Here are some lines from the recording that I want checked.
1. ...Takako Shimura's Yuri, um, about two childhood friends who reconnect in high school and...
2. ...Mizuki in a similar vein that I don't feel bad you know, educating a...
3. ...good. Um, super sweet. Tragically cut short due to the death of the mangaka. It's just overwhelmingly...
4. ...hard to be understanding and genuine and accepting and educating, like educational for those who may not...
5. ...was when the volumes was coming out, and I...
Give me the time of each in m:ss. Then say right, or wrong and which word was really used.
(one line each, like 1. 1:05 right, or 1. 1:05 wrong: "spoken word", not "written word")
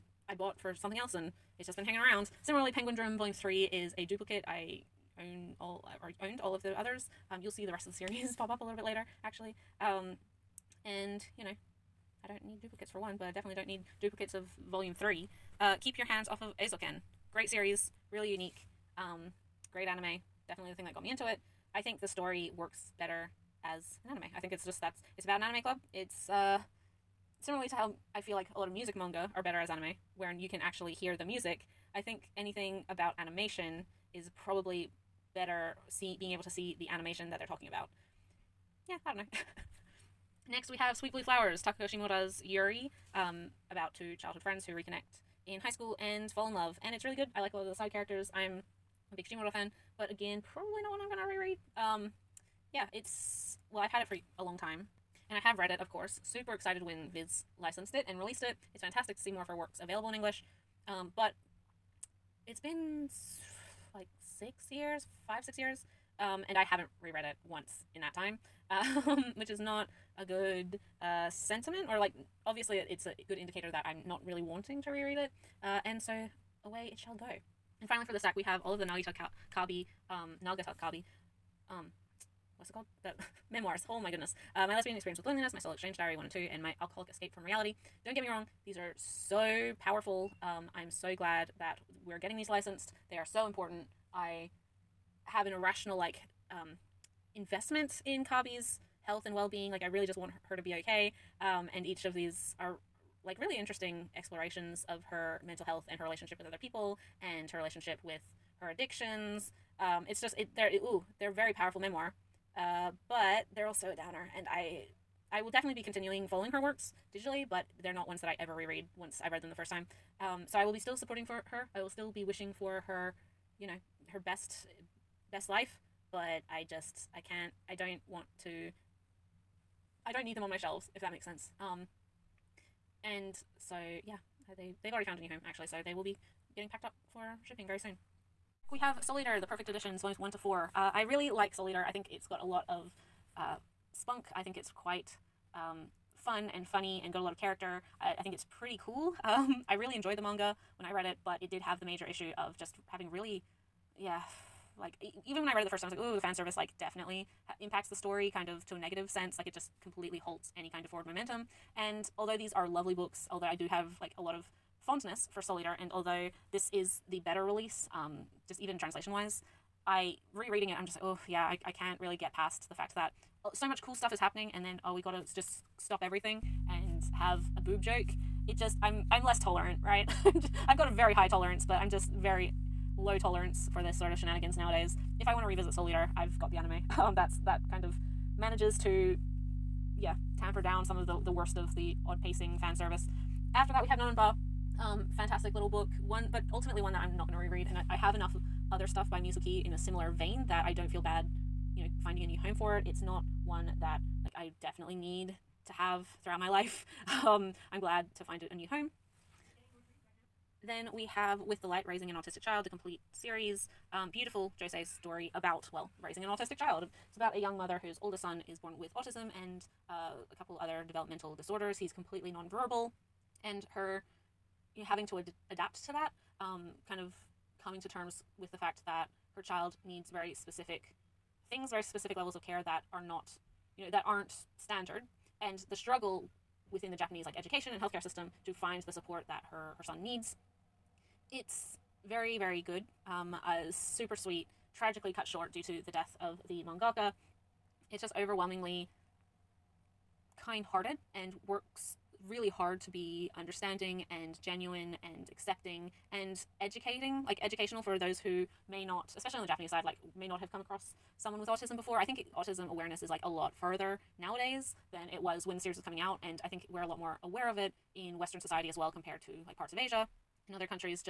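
1. 0:41 right
2. 3:19 wrong: "finding", not "educating"
3. 4:02 right
4. 4:12 right
5. 4:25 wrong: "series", not "volumes".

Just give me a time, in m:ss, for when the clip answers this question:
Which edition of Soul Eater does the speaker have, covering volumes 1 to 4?
2:19.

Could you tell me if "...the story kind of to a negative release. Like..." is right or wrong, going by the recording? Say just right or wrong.
wrong.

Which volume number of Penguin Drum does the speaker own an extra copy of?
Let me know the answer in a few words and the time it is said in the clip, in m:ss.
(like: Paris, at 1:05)
3, at 0:02.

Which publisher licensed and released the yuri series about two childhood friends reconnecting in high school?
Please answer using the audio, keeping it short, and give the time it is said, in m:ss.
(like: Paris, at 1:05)
Viz, at 0:57.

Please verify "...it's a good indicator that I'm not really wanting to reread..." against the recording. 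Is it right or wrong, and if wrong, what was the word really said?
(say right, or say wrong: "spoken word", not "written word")
right.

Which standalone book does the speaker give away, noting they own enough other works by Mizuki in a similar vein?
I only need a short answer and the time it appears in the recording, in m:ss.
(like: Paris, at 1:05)
NonNonBa, at 3:13.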